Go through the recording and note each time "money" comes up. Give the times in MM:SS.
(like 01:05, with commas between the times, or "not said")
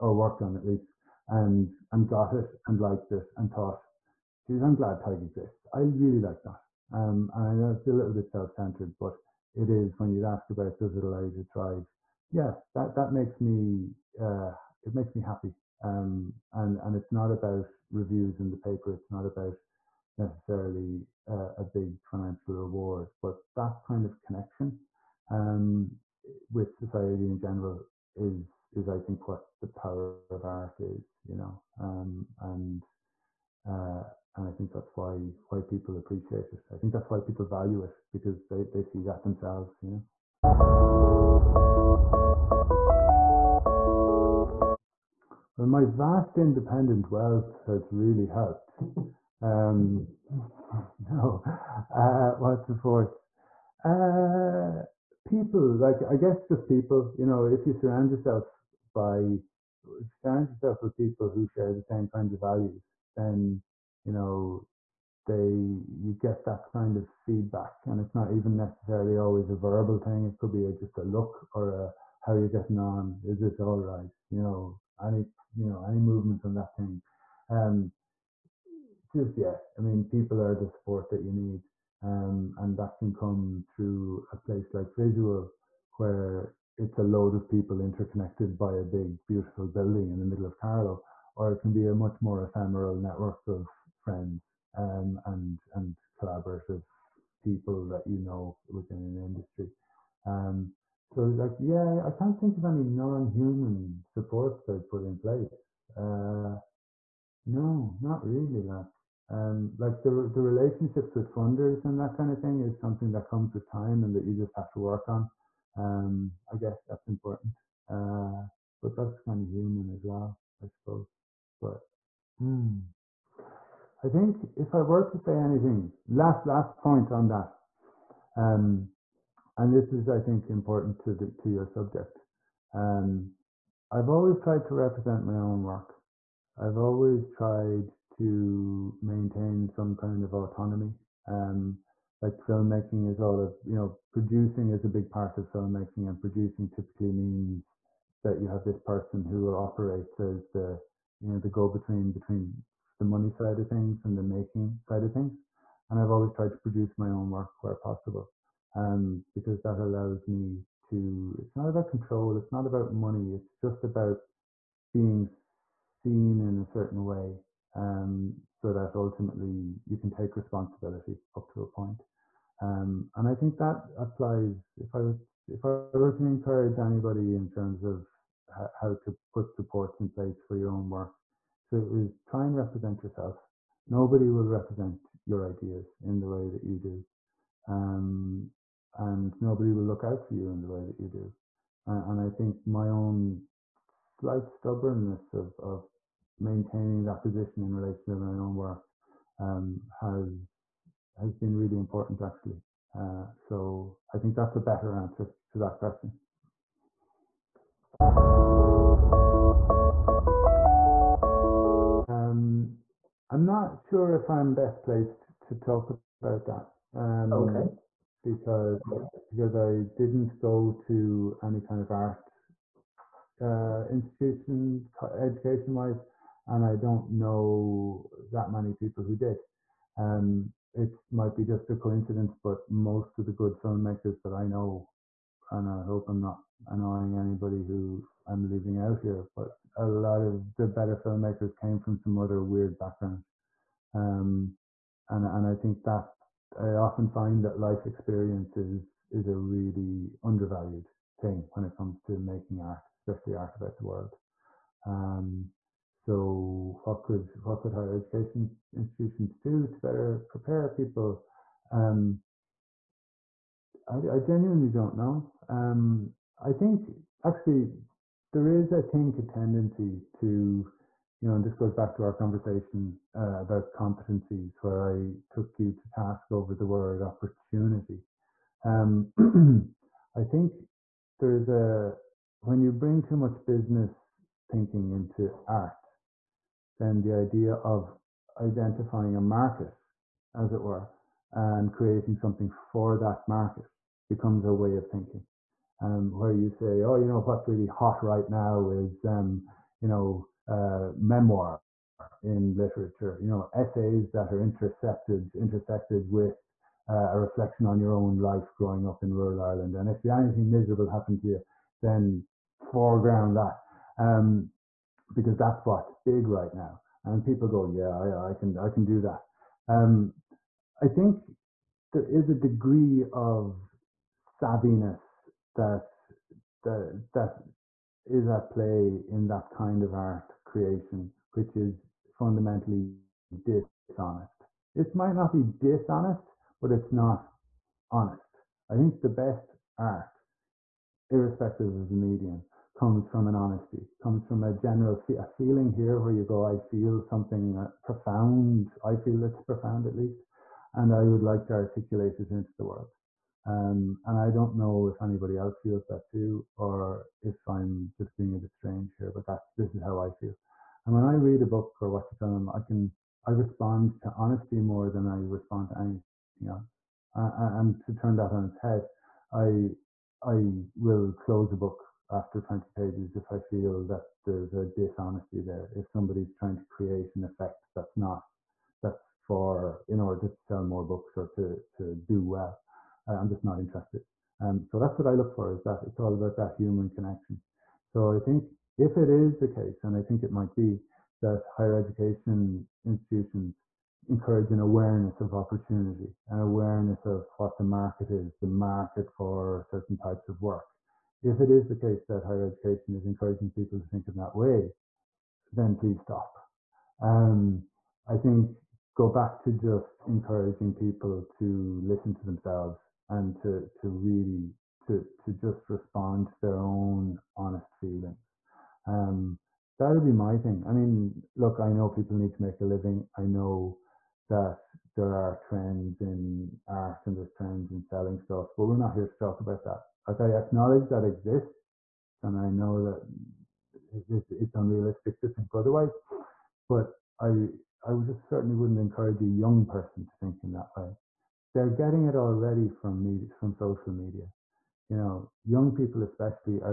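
02:33, 02:42.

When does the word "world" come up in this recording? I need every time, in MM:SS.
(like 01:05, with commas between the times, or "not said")
04:13, 05:52.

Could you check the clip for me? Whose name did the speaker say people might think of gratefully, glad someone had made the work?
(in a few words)
Tadhg.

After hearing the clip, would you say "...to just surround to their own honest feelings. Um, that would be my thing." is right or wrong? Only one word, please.
wrong.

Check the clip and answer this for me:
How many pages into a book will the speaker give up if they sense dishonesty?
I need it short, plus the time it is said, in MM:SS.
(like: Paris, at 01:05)
20, at 06:12.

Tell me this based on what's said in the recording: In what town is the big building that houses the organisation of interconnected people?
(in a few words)
Carlow.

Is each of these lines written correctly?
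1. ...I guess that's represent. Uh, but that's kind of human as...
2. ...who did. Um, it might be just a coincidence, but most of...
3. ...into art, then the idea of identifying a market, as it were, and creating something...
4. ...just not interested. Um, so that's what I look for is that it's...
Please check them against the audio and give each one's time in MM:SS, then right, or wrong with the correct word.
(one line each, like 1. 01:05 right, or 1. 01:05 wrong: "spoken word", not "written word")
1. 01:56 wrong: "important", not "represent"
2. 03:49 right
3. 04:44 right
4. 06:23 right.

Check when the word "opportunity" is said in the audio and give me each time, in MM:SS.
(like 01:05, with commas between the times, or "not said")
04:37, 06:35.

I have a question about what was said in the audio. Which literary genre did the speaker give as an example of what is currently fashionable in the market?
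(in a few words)
memoir.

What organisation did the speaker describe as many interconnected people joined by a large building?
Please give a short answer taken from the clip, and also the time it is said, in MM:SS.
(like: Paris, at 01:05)
Visual, at 01:24.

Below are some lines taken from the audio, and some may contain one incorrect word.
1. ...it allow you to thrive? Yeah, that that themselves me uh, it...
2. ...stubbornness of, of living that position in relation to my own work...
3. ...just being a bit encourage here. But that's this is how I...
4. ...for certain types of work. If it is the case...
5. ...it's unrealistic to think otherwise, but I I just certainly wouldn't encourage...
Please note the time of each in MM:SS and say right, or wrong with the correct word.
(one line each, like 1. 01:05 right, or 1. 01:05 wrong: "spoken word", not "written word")
1. 00:10 wrong: "makes", not "themselves"
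2. 03:14 wrong: "maintaining", not "living"
3. 05:57 wrong: "strange", not "encourage"
4. 06:39 right
5. 07:14 right.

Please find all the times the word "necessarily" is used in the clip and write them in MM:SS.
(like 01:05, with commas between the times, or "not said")
00:20, 01:08.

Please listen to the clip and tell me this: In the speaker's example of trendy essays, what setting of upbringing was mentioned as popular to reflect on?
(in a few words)
rural Ireland.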